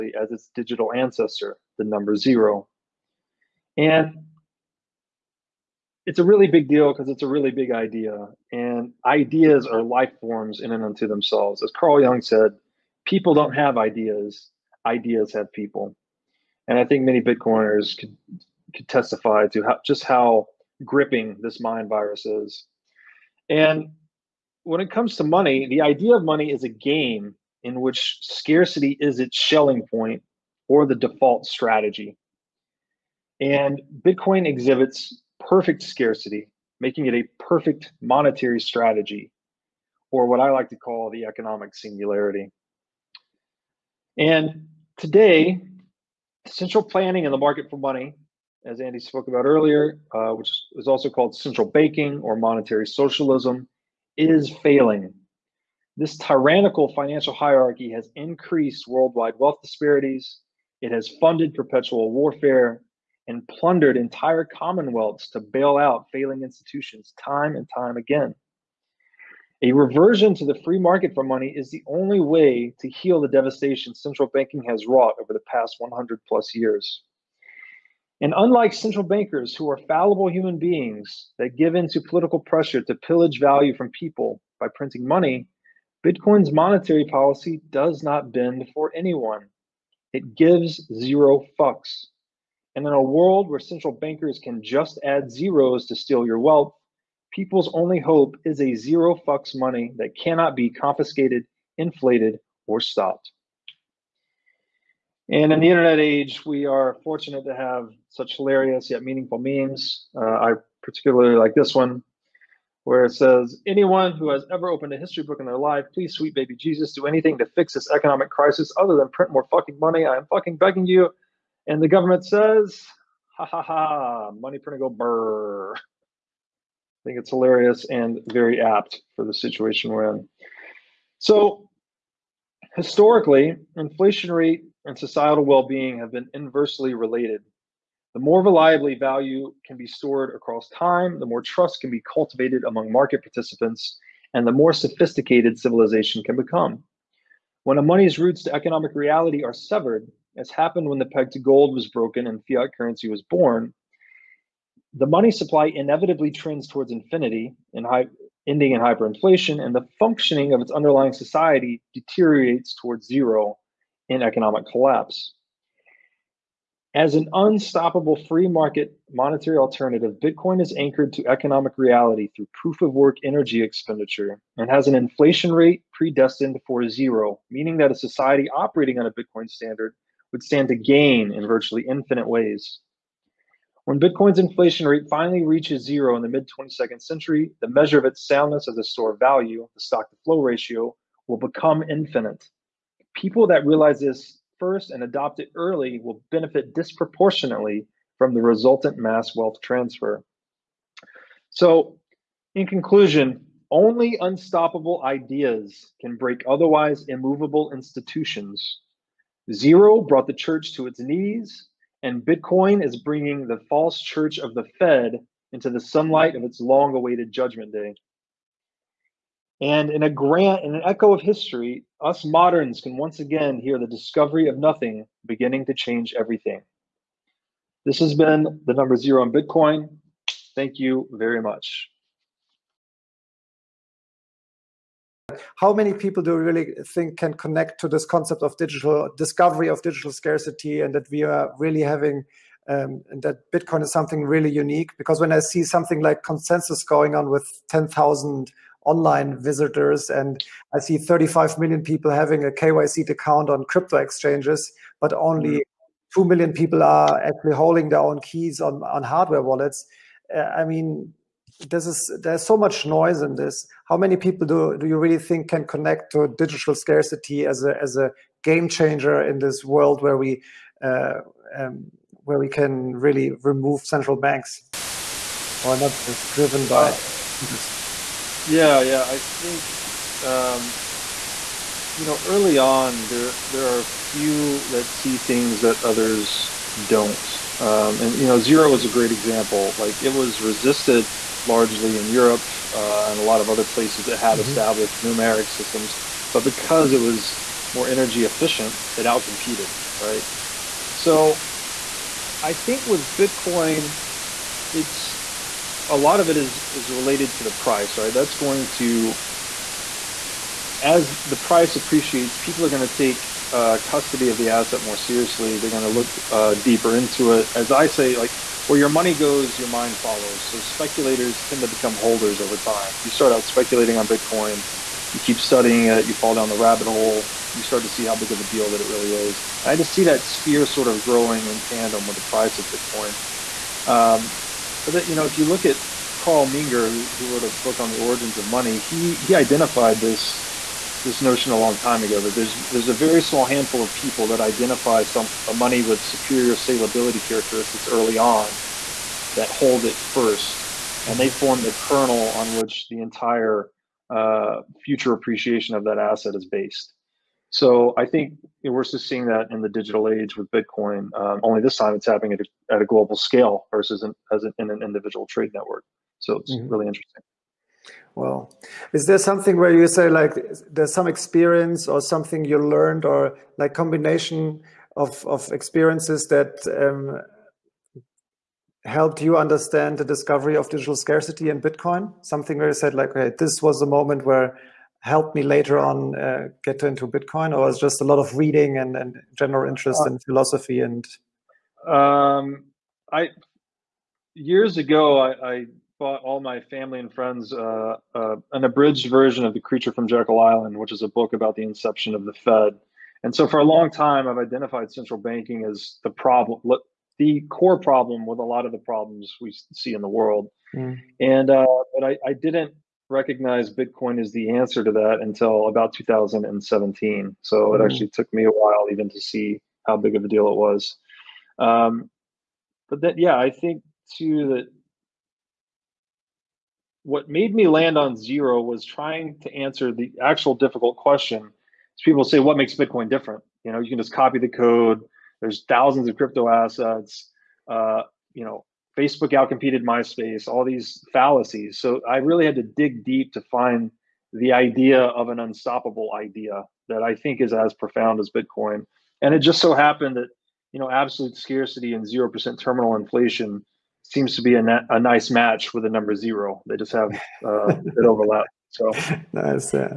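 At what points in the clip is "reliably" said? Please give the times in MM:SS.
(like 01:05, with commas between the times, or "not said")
02:18.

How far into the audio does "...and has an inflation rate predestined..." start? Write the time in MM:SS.
02:54.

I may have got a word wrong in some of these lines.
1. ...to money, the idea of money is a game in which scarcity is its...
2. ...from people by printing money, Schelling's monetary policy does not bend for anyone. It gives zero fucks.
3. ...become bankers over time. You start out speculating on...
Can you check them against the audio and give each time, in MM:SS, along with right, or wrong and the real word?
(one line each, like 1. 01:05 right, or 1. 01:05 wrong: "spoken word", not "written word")
1. 00:25 right
2. 01:23 wrong: "Bitcoin", not "Schelling"
3. 05:21 wrong: "holders", not "bankers".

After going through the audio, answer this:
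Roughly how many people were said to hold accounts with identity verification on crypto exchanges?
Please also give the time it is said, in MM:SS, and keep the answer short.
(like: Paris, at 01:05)
35 million, at 04:10.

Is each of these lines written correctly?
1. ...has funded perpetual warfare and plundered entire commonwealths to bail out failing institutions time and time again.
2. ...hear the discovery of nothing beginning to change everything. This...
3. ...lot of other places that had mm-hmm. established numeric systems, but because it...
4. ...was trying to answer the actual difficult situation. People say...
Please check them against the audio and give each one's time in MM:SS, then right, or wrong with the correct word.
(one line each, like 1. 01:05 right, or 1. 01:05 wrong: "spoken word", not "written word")
1. 01:00 right
2. 03:43 right
3. 04:53 right
4. 07:08 wrong: "question", not "situation".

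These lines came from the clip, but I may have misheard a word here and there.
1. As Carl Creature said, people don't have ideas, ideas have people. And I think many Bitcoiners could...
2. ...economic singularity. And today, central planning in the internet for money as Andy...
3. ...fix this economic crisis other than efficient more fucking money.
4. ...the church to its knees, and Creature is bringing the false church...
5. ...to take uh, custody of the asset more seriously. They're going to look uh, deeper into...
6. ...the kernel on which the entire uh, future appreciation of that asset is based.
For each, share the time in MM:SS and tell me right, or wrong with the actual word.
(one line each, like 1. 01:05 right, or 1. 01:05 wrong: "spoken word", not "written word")
1. 00:11 wrong: "Jung", not "Creature"
2. 00:41 wrong: "market", not "internet"
3. 01:57 wrong: "print", not "efficient"
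4. 03:30 wrong: "Bitcoin", not "Creature"
5. 05:12 right
6. 05:51 right.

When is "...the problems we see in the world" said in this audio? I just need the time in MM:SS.
06:48.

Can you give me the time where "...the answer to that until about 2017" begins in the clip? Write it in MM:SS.
06:54.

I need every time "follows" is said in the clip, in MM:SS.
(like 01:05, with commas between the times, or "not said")
05:20.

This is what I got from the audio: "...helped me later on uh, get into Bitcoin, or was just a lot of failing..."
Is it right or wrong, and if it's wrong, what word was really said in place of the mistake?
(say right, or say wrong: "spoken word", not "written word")
wrong: "reading", not "failing".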